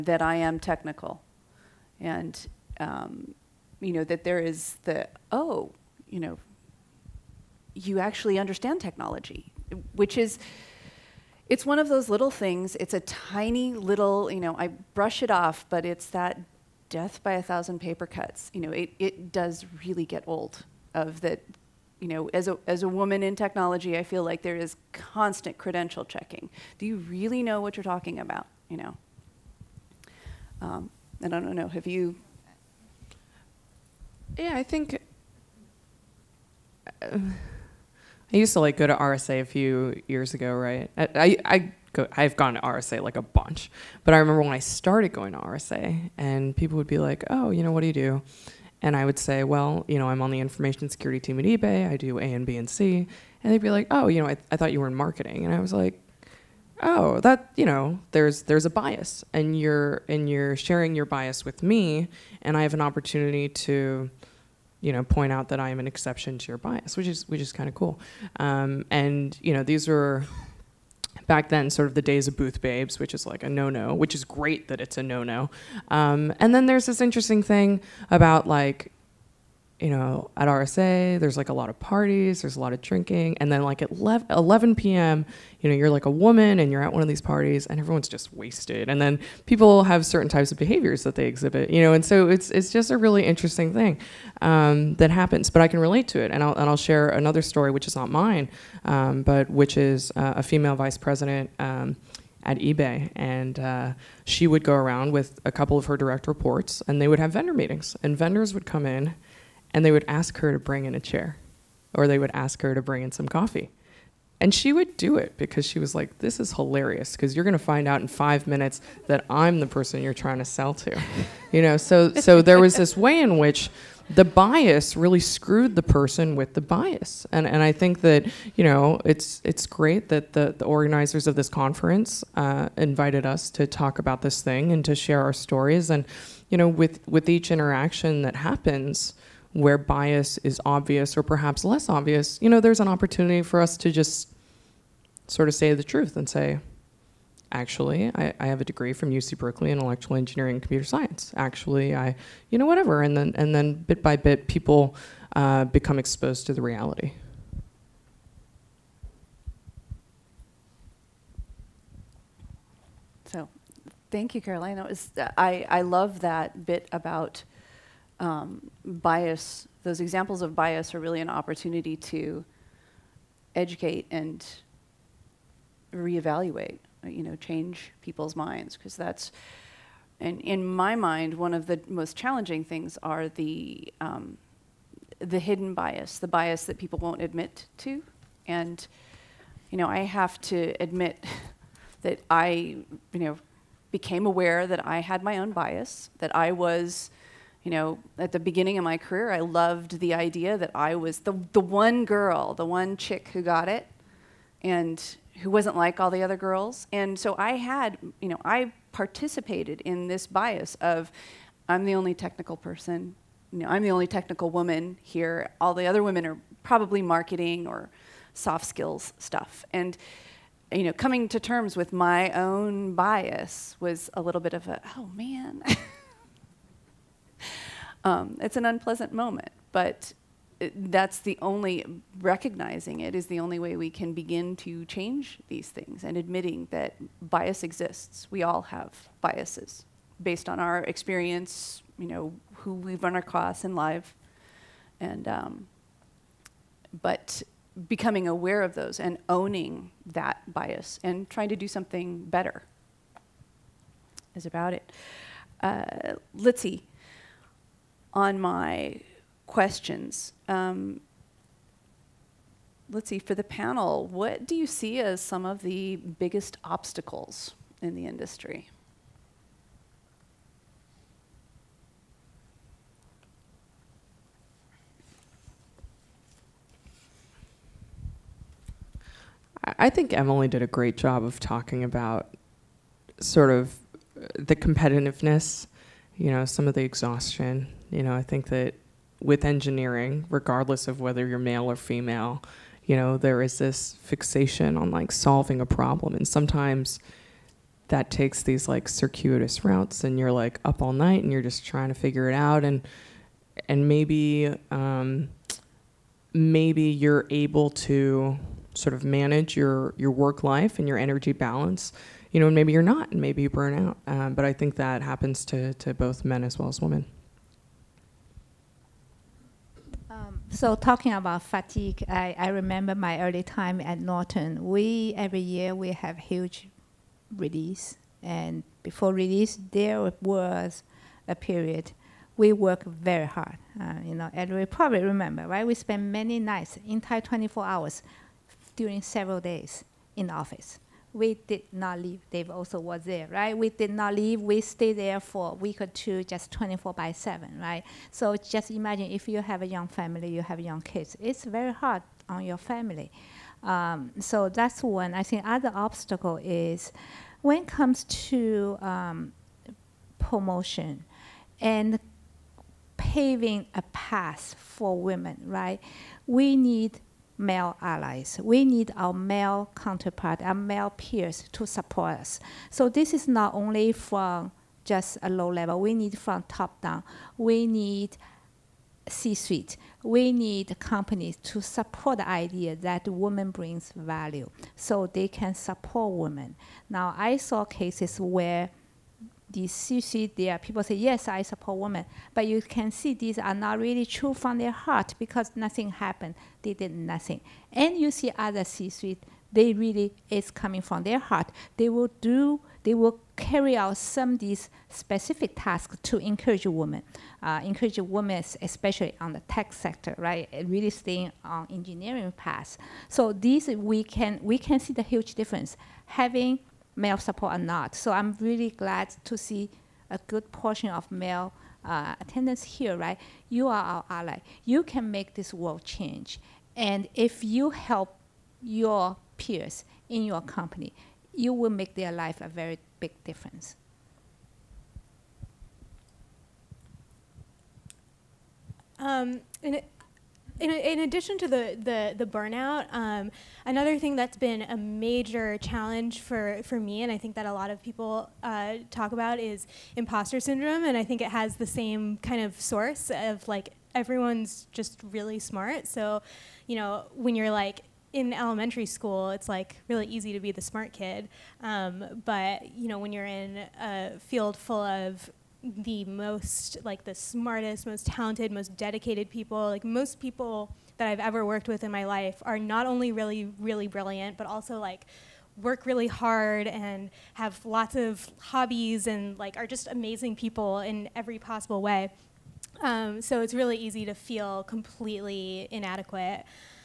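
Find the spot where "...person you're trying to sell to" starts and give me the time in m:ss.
1:59.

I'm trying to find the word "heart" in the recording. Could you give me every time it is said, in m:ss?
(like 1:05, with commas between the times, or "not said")
6:34, 6:41.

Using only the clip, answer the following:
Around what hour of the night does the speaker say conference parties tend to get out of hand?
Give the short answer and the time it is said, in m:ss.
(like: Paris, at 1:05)
11 p.m., at 1:23.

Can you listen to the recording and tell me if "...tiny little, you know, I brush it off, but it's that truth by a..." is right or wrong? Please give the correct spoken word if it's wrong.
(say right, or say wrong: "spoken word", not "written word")
wrong: "death", not "truth".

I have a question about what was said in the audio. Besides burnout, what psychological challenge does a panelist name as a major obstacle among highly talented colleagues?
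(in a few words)
Imposter syndrome.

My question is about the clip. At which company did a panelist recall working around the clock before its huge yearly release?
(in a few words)
Norton.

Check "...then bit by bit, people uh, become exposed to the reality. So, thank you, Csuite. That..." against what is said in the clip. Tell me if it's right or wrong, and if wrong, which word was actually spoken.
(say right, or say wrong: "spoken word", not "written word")
wrong: "Caroline", not "Csuite".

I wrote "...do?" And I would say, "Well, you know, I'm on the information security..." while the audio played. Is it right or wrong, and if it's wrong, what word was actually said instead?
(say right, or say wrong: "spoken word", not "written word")
right.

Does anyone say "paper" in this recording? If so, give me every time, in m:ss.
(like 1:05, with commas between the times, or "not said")
0:17.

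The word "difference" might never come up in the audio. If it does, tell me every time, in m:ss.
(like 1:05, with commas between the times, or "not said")
6:55, 7:13.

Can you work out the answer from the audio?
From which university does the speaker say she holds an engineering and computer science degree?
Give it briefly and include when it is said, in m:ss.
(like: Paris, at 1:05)
UC Berkeley, at 2:29.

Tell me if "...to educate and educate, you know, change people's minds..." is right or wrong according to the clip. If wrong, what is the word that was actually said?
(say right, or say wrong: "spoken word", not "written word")
wrong: "reevaluate", not "educate".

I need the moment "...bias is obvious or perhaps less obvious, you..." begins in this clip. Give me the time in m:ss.
2:19.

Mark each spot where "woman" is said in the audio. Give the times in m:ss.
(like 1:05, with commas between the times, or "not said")
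0:22, 1:26, 3:34.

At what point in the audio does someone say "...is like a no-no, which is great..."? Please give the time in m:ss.
1:13.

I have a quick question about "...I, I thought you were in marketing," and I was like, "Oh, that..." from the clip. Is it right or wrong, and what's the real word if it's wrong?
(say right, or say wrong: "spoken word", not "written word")
right.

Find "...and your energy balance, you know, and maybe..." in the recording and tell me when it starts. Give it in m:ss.
5:10.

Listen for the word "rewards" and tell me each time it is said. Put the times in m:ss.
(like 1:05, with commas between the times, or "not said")
not said.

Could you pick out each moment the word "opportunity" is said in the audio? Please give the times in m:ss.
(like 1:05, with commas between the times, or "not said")
1:02, 2:22, 2:51.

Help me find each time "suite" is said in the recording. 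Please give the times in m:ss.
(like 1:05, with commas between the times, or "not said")
6:19, 6:29, 6:38.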